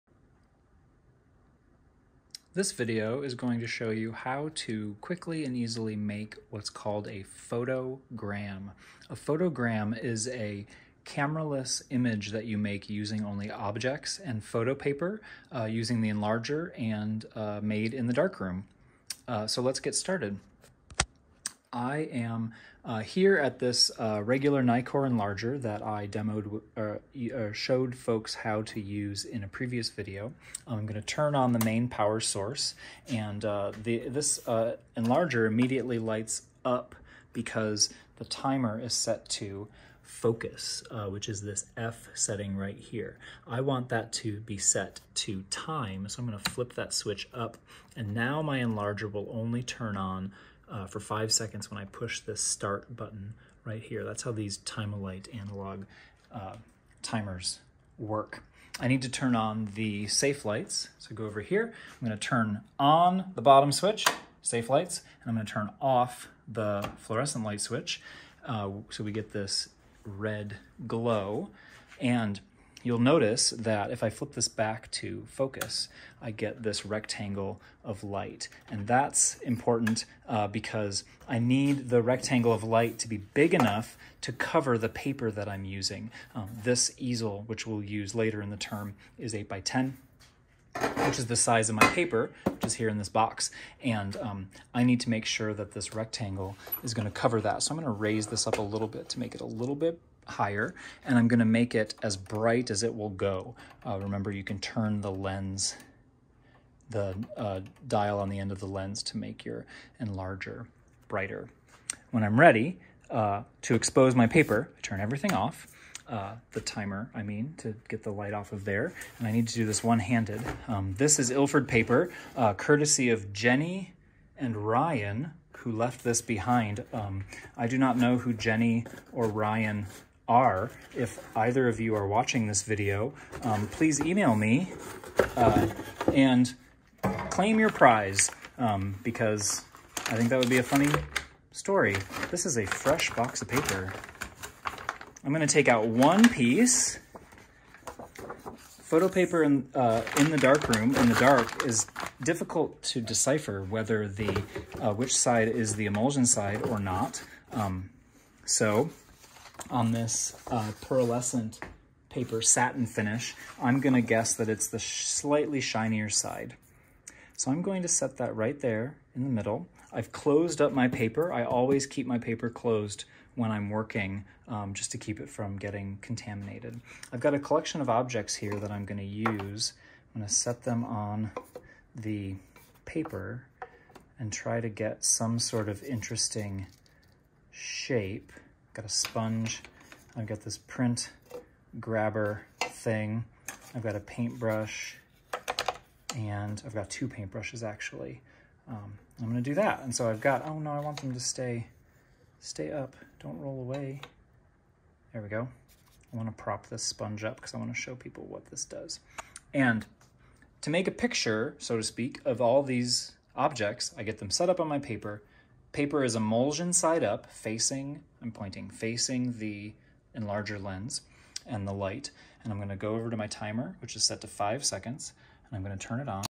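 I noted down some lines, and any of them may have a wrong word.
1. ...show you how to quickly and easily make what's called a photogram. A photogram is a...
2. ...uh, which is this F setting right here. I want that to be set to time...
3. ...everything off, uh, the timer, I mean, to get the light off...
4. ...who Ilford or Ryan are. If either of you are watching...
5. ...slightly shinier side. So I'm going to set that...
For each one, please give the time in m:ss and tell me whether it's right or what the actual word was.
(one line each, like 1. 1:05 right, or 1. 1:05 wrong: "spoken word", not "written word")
1. 0:03 right
2. 0:40 right
3. 1:55 right
4. 2:08 wrong: "Jenny", not "Ilford"
5. 2:44 right.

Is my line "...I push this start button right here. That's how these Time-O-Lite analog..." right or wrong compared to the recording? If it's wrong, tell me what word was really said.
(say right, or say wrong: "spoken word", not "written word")
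right.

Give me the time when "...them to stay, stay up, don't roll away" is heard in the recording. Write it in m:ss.
3:21.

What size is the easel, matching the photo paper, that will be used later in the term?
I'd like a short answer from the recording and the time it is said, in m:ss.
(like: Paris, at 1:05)
8 by 10, at 1:29.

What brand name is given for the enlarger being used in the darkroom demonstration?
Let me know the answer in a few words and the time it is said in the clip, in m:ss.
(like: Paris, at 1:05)
Nikkor, at 0:24.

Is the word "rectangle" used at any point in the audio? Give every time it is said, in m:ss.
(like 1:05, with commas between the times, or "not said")
1:16, 1:22, 1:35.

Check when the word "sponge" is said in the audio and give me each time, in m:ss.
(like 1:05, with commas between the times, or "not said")
3:08, 3:26.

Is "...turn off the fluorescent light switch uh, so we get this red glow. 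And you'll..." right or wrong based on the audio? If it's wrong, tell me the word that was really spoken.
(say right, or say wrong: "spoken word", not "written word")
right.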